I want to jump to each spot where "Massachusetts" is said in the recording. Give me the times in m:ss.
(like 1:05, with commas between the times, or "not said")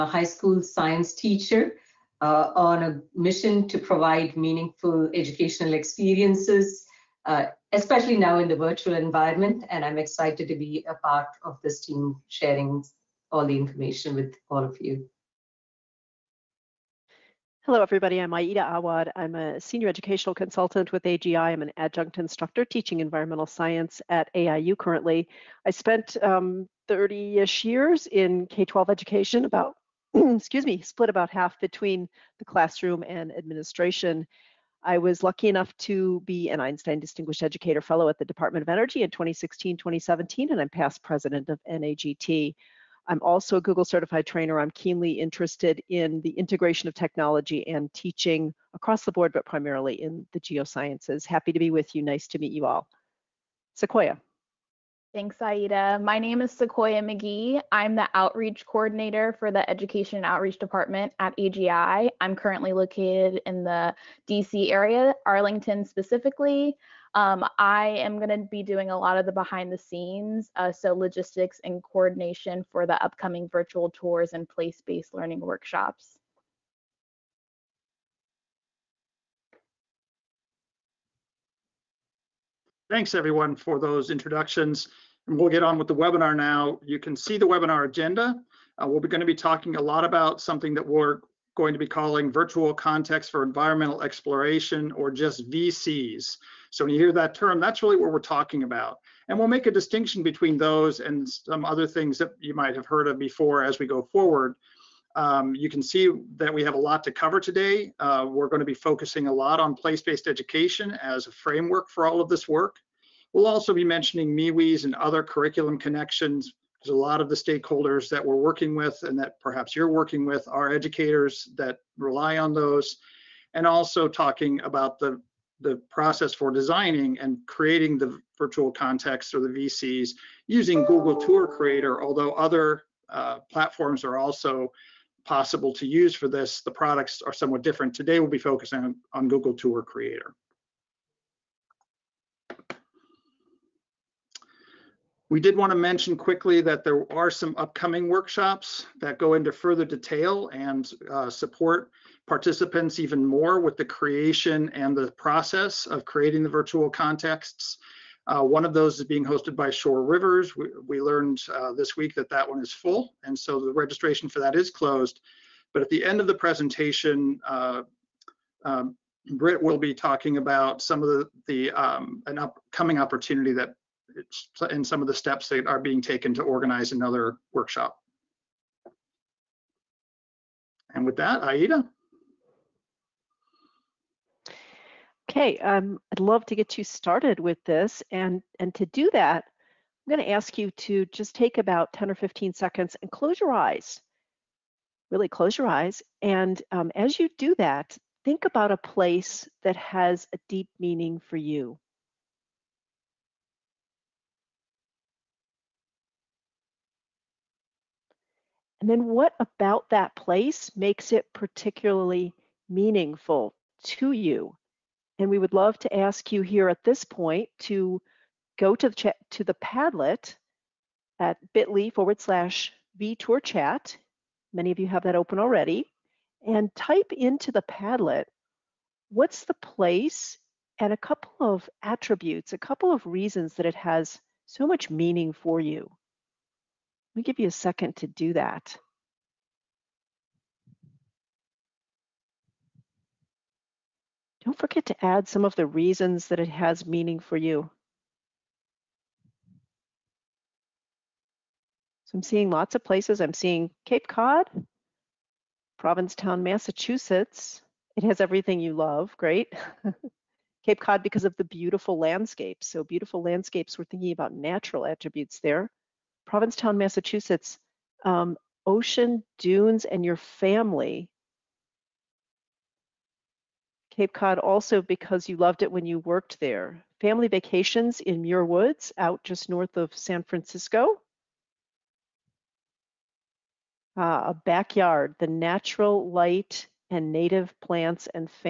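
4:16, 4:26.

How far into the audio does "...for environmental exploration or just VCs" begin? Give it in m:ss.
1:33.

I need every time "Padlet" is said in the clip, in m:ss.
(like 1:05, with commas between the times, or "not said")
3:39, 3:47.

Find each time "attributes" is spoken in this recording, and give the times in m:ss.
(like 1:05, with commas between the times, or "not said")
3:51, 4:24.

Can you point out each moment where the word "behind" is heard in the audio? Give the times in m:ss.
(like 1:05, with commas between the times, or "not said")
1:09.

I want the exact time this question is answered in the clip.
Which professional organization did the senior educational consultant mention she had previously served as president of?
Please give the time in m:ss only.
0:41.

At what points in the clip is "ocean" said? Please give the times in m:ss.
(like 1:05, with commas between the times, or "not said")
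4:28.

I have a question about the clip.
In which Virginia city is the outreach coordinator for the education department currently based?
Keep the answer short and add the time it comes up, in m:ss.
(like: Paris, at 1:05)
Arlington, at 1:05.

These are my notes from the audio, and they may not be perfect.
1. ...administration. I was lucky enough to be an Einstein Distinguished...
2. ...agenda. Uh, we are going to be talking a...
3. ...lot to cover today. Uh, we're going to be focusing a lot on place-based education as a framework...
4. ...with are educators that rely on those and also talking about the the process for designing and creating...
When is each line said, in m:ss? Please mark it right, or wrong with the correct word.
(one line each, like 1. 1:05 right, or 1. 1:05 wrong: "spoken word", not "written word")
1. 0:33 right
2. 1:27 right
3. 1:46 right
4. 2:00 right.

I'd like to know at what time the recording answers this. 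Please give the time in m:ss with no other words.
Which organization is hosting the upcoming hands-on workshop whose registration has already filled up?
2:39.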